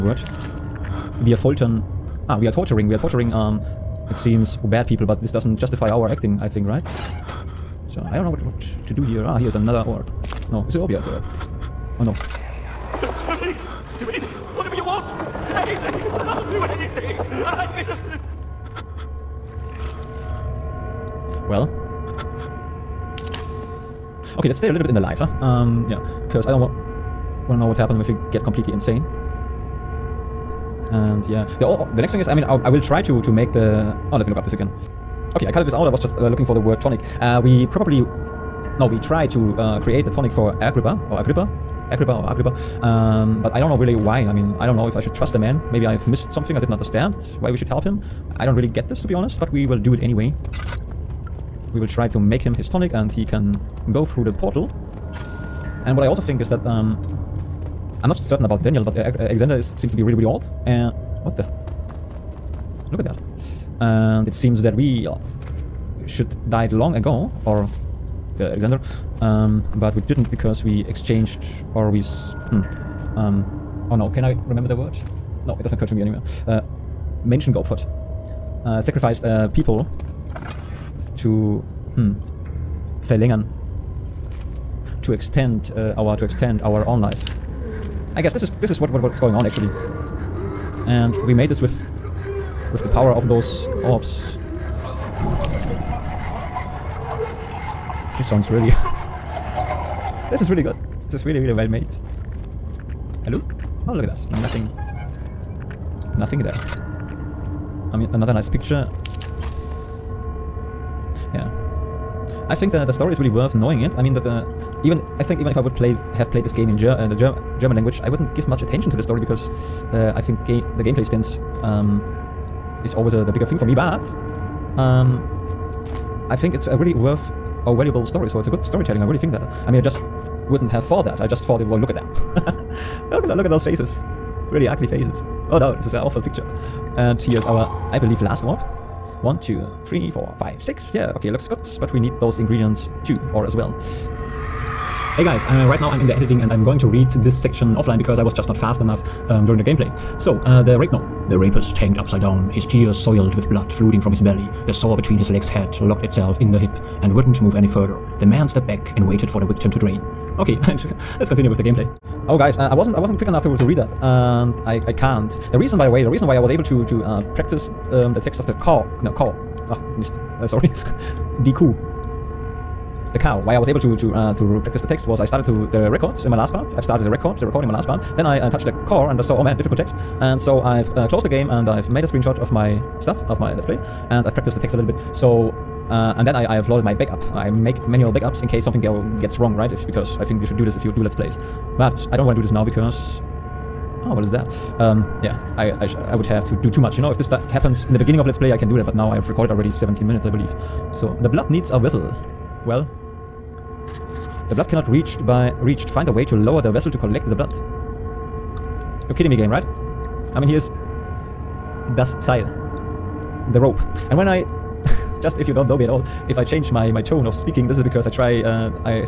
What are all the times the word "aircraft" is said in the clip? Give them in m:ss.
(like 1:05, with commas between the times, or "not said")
not said.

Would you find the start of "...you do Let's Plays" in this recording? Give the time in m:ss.
3:10.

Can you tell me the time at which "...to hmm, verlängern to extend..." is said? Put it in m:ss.
1:21.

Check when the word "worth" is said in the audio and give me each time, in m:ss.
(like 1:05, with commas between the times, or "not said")
1:53, 2:06.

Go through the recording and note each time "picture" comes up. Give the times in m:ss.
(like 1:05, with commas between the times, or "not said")
1:48, 2:16.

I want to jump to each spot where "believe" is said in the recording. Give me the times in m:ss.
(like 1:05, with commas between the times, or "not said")
2:17, 3:20.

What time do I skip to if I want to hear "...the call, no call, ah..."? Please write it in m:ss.
2:48.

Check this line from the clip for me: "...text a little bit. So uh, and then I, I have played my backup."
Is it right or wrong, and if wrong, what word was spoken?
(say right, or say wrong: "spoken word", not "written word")
wrong: "loaded", not "played".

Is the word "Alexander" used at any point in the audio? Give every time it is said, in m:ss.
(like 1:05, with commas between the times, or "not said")
0:59, 1:08.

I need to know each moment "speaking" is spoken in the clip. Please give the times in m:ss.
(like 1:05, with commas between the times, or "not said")
3:37.